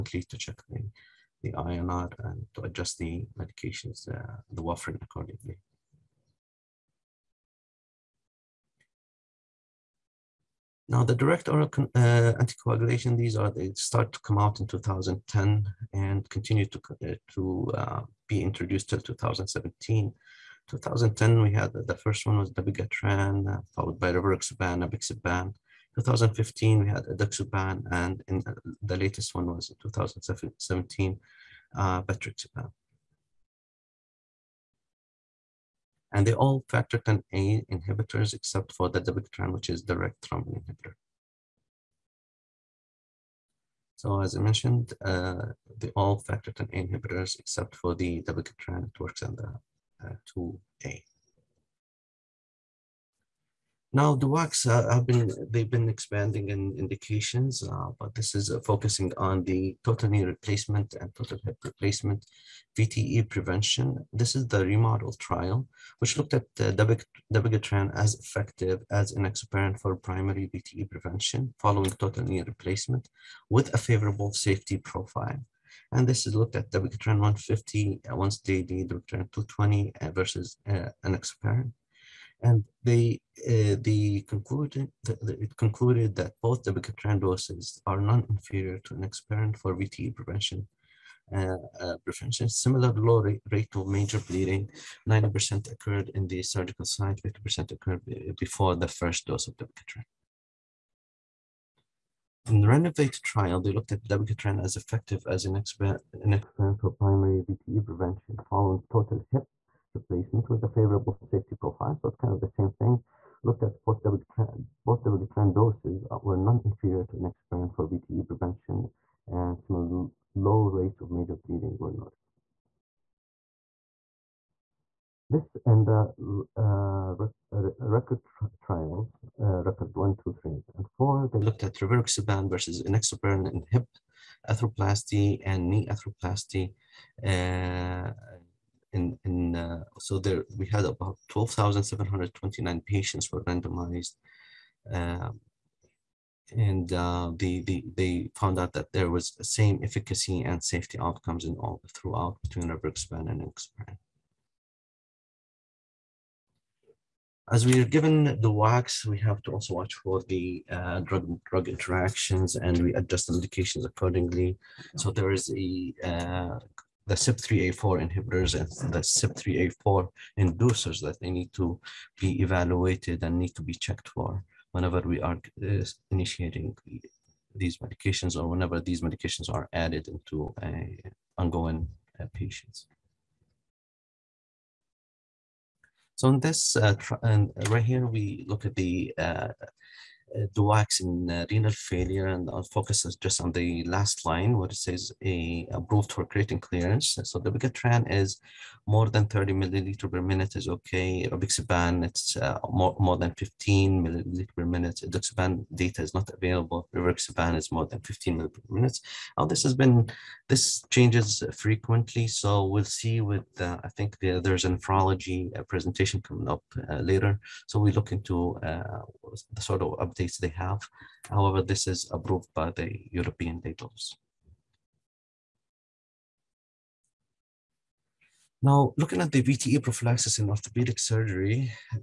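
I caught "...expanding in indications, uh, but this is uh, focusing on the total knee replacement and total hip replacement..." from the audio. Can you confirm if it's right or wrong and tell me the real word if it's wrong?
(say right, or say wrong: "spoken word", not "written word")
right.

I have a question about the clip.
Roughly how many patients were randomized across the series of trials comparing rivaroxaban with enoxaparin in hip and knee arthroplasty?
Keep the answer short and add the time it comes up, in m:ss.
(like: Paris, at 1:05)
12,729, at 2:21.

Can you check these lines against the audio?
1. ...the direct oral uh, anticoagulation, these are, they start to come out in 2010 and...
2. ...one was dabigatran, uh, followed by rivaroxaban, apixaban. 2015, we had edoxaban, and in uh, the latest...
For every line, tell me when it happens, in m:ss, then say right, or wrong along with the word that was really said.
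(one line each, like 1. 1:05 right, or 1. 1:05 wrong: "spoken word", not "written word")
1. 0:11 right
2. 0:22 right.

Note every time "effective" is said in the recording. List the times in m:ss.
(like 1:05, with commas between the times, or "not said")
1:08, 1:44.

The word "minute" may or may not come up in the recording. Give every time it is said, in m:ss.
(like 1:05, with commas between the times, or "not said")
3:20, 3:24, 3:28.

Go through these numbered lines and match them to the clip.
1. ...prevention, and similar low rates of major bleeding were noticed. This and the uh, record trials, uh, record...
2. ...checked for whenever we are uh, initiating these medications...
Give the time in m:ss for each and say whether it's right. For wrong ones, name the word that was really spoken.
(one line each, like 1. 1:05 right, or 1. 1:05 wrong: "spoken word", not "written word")
1. 1:58 right
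2. 2:53 right.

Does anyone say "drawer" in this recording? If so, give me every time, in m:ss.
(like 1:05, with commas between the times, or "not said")
not said.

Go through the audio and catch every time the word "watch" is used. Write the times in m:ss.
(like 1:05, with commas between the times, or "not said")
2:39.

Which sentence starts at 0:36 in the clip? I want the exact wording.
And they all factor 10A inhibitors except for the dabigatran, which is direct thrombin inhibitor.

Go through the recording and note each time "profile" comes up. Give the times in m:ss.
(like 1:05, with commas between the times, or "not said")
1:14, 1:51.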